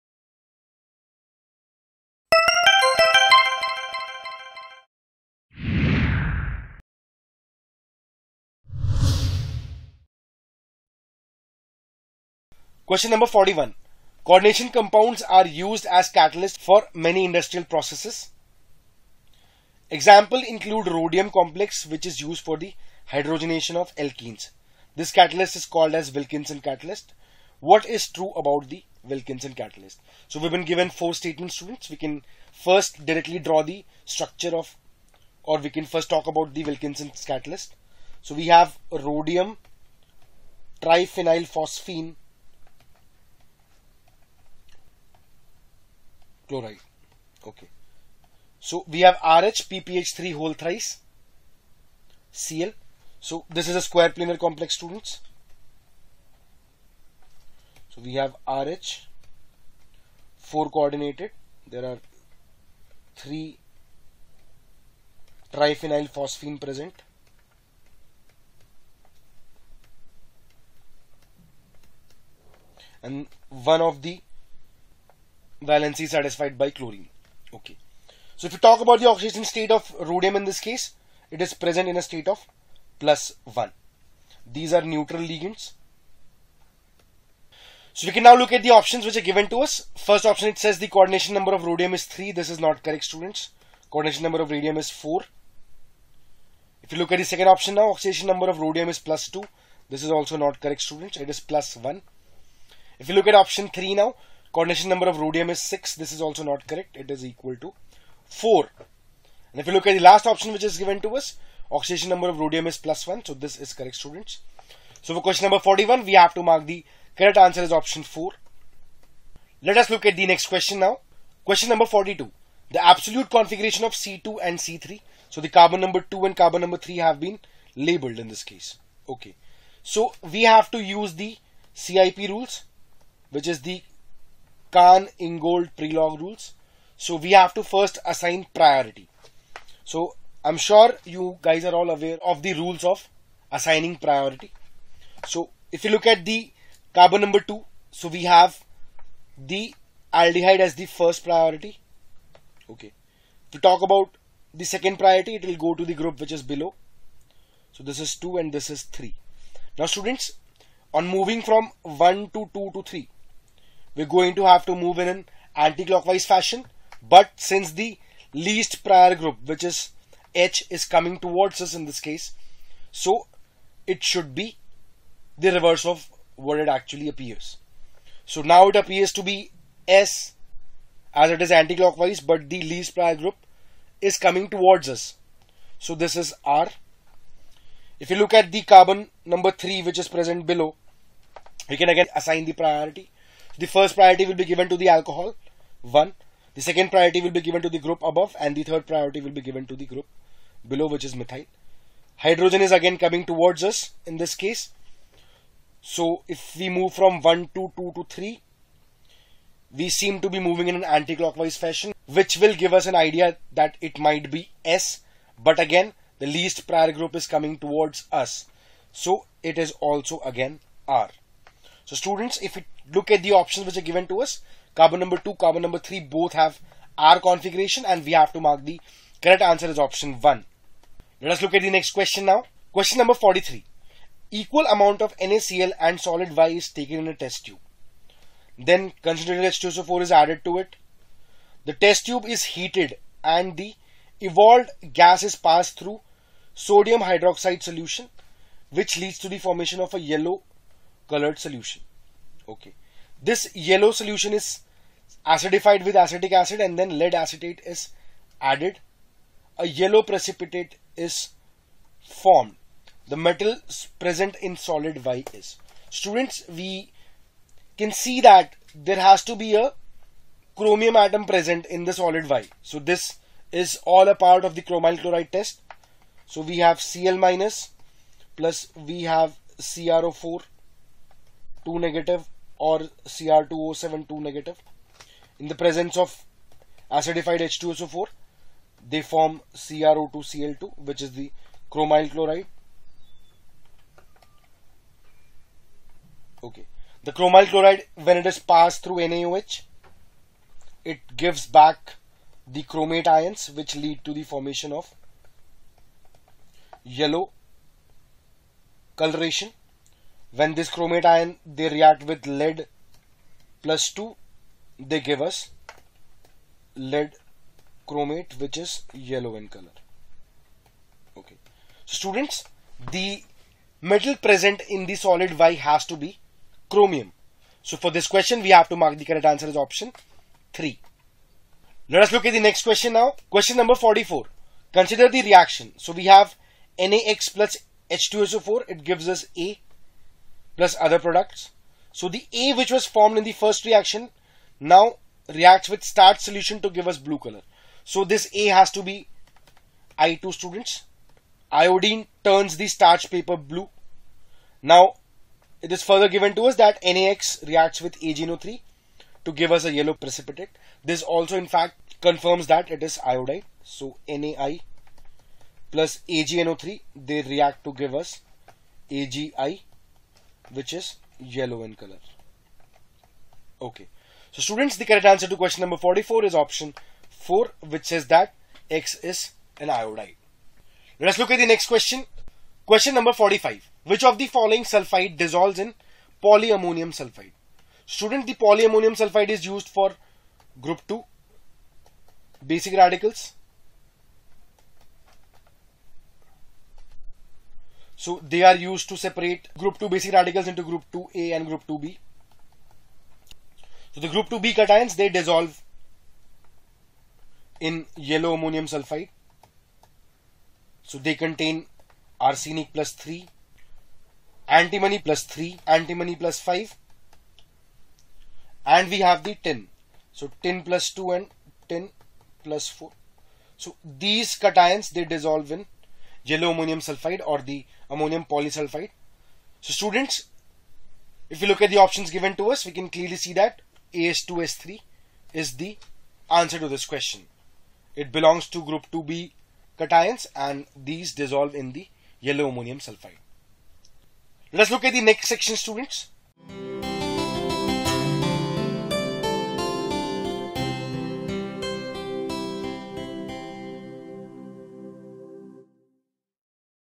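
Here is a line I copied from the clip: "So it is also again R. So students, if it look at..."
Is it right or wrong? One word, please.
right.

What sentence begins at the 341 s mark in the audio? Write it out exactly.
So the A which was formed in the first reaction now reacts with starch solution to give us blue color.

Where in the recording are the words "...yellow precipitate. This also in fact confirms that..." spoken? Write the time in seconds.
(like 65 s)
359 s.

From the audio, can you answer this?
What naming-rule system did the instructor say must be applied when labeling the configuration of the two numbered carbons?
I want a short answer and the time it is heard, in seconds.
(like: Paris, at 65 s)
Cahn Ingold Prelog rules, at 134 s.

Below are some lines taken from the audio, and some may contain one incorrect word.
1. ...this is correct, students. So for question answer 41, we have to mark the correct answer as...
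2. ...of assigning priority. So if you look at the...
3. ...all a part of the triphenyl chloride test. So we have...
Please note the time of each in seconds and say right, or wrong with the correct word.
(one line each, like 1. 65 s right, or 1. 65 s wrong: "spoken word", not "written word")
1. 113 s wrong: "number", not "answer"
2. 142 s right
3. 273 s wrong: "chromyl", not "triphenyl".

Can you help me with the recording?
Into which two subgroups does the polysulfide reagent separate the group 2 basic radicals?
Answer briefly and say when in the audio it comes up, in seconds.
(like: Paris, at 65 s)
group 2A and group 2B, at 400 s.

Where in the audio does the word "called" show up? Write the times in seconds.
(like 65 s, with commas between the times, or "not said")
25 s.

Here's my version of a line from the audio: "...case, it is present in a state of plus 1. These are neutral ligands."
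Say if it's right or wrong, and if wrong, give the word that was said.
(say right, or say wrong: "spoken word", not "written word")
right.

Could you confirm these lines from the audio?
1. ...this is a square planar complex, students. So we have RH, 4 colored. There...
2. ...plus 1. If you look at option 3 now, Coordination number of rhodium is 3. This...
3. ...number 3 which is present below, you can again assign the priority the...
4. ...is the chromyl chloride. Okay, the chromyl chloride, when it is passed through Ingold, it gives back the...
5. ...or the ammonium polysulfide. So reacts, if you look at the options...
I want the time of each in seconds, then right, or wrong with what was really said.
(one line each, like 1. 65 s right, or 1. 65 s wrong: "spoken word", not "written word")
1. 53 s wrong: "coordinated", not "colored"
2. 101 s wrong: "6", not "3"
3. 189 s right
4. 291 s wrong: "NaOH", not "Ingold"
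5. 427 s wrong: "students", not "reacts".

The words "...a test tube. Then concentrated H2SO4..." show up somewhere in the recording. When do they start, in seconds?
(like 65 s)
237 s.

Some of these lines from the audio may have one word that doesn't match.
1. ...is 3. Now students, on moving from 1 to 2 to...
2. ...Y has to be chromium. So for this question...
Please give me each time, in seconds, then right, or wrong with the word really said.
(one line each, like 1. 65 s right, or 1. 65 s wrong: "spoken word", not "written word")
1. 158 s right
2. 325 s right.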